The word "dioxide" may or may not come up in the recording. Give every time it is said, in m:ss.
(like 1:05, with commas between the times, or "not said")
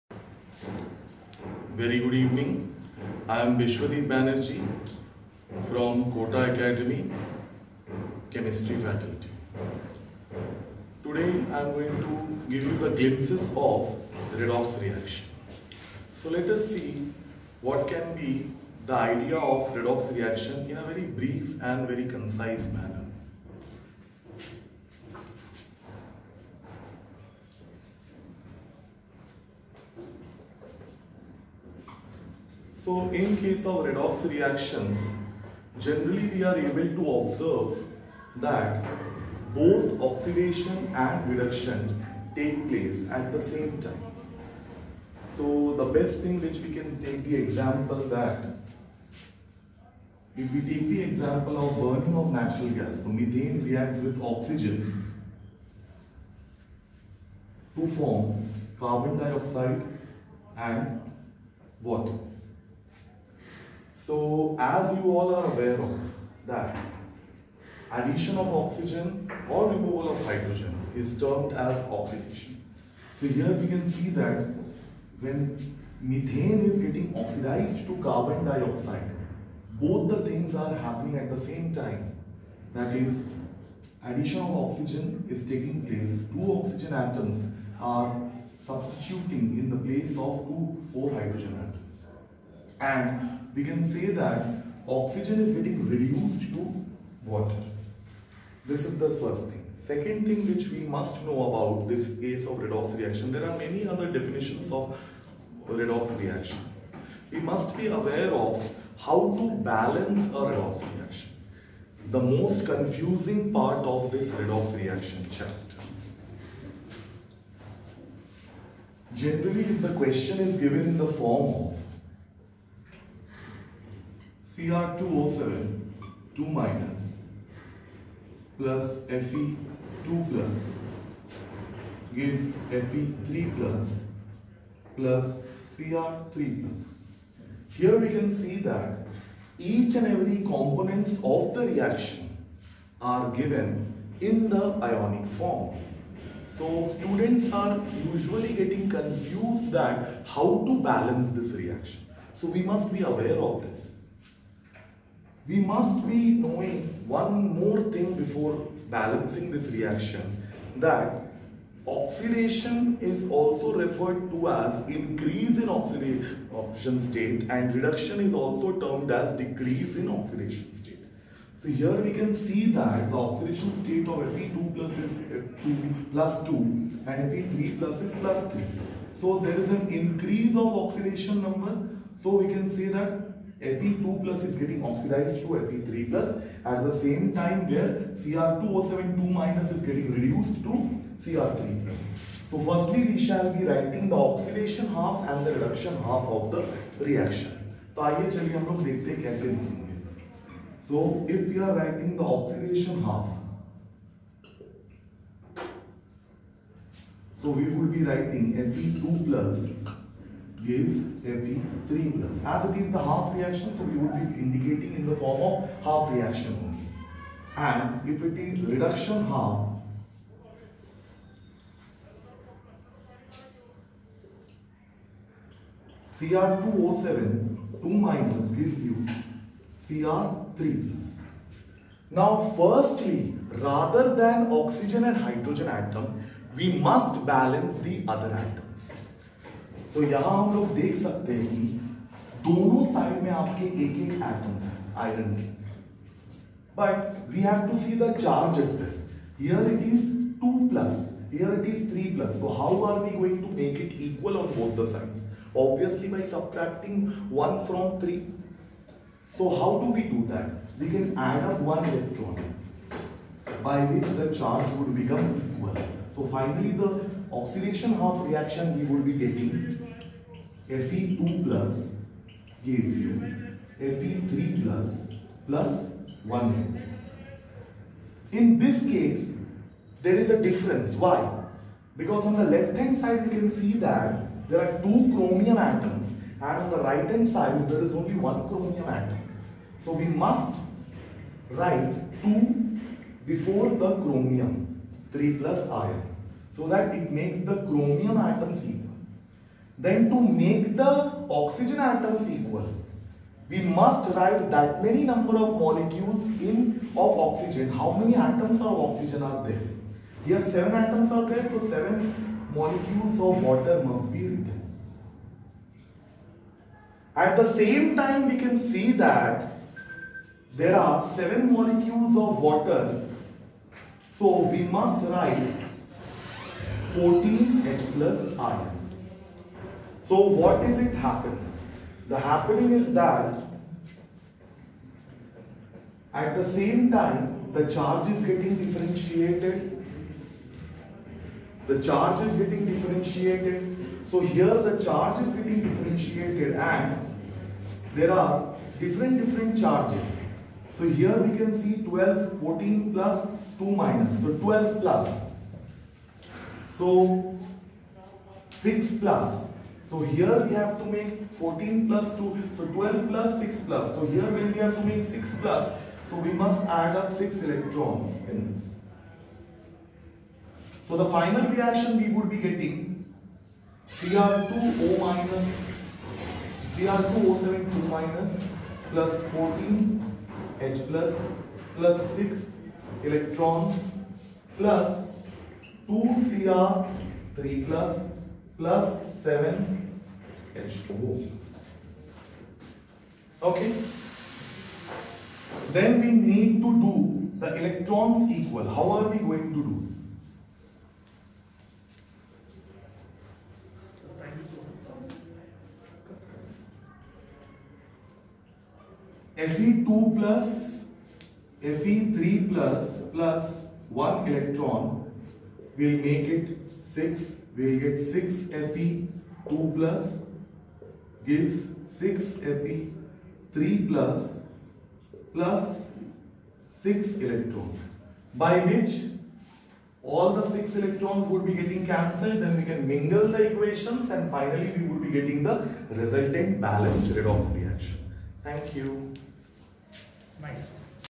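0:59, 1:18.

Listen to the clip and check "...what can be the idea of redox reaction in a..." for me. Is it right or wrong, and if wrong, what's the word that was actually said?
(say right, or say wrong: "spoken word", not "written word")
right.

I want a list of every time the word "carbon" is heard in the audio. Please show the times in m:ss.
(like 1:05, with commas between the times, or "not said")
0:58, 1:18.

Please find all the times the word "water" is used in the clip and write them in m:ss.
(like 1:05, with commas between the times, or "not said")
1:01, 1:37, 5:13, 5:22.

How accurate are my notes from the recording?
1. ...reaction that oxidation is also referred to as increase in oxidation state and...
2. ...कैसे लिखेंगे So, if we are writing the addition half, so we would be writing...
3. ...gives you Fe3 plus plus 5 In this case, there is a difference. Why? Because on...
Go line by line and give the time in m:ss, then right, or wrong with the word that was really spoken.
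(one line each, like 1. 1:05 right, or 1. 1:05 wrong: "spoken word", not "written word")
1. 2:39 right
2. 3:19 wrong: "oxidation", not "addition"
3. 4:32 wrong: "1", not "5".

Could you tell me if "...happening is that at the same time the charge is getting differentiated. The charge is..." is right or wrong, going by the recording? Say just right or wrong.
right.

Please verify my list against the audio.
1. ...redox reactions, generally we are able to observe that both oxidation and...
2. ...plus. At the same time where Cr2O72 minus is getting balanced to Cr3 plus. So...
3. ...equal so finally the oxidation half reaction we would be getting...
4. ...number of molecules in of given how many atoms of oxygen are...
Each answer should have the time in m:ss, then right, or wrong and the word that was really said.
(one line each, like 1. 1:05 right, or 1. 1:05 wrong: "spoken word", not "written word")
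1. 0:33 right
2. 3:06 wrong: "reduced", not "balanced"
3. 4:25 right
4. 5:05 wrong: "oxygen", not "given".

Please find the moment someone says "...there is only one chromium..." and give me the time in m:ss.
4:47.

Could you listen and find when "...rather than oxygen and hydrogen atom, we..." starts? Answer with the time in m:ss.
3:53.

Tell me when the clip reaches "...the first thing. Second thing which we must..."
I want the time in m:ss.
1:38.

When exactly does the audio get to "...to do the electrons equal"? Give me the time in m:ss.
6:36.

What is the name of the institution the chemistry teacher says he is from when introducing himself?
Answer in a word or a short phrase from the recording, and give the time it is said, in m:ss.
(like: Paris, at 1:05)
Kota Academy, at 0:06.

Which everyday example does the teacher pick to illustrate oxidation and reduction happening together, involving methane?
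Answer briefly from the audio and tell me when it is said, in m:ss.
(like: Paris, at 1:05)
Burning of natural gas, at 0:51.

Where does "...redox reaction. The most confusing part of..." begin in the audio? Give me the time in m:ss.
1:50.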